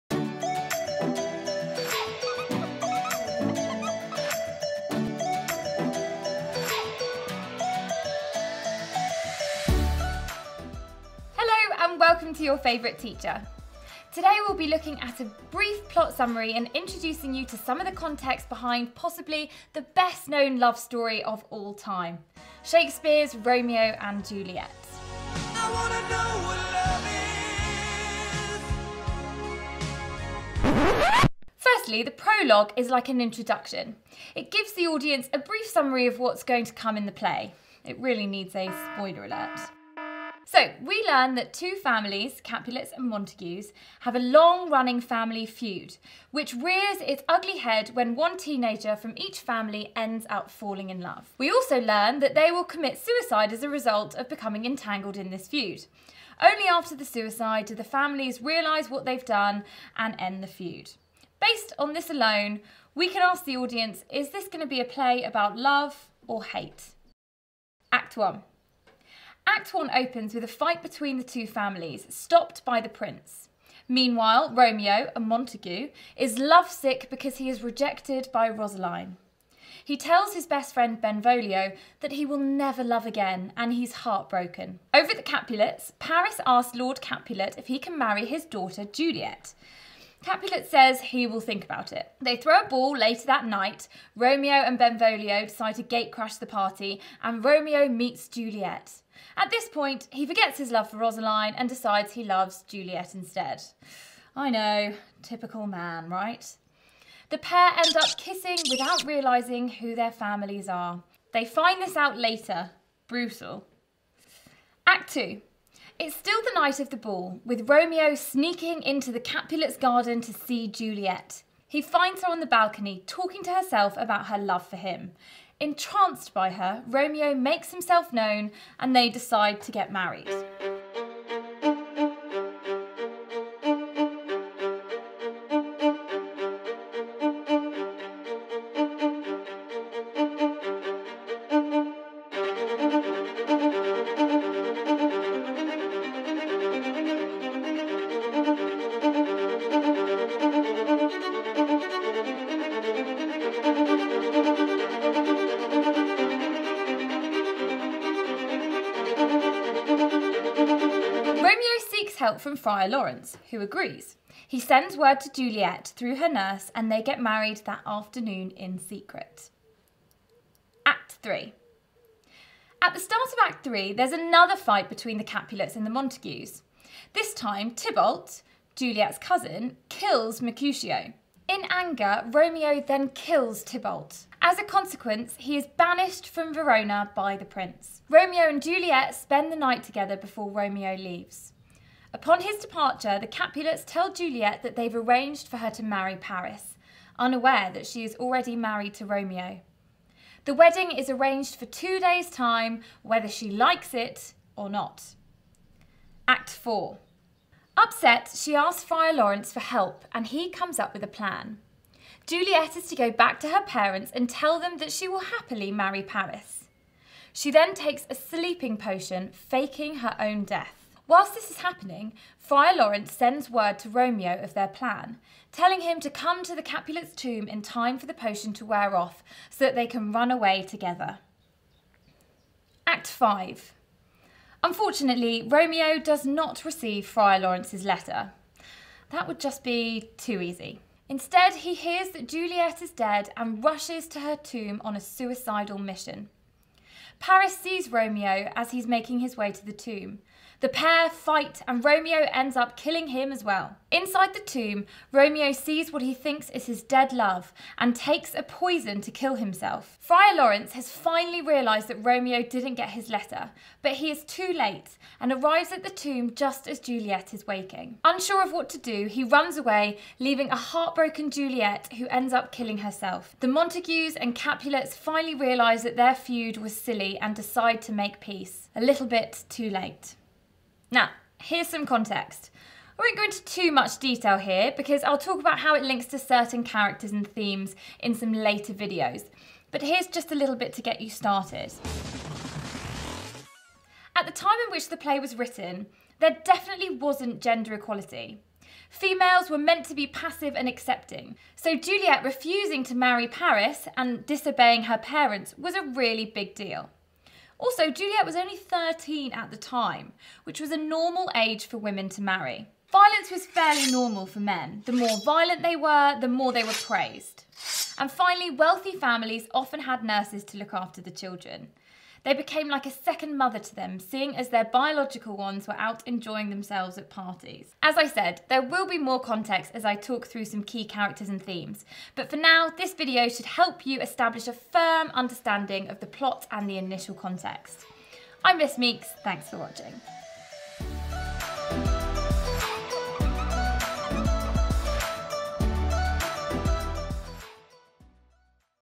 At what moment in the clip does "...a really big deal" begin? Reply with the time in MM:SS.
05:05.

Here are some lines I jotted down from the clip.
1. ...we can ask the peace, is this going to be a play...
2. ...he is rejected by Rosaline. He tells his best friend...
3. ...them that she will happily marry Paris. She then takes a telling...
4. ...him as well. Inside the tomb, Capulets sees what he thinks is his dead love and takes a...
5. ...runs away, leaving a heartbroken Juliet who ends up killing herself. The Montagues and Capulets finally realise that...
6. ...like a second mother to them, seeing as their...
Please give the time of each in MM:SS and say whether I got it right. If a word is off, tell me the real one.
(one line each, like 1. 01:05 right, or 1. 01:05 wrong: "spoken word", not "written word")
1. 01:02 wrong: "audience", not "peace"
2. 01:17 right
3. 03:34 wrong: "sleeping", not "telling"
4. 04:13 wrong: "Romeo", not "Capulets"
5. 04:29 right
6. 05:22 right.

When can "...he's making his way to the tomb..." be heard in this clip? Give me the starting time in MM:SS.
04:08.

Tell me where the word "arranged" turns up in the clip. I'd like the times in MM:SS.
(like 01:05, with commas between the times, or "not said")
03:14, 03:21.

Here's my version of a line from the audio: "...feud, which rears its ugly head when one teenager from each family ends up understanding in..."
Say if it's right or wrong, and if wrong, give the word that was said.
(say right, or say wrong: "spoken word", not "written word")
wrong: "falling", not "understanding".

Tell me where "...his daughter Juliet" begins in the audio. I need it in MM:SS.
01:28.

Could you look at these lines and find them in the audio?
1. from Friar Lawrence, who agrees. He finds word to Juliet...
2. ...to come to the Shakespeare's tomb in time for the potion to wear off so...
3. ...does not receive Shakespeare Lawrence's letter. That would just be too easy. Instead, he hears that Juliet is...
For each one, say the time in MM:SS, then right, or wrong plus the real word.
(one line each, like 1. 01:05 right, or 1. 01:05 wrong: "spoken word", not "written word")
1. 02:42 wrong: "sends", not "finds"
2. 03:45 wrong: "Capulet", not "Shakespeare"
3. 03:55 wrong: "Friar", not "Shakespeare".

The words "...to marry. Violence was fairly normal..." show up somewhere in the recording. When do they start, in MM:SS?
05:12.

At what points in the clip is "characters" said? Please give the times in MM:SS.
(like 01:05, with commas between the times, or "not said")
04:46, 05:30.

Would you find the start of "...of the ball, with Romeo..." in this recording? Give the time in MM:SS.
01:56.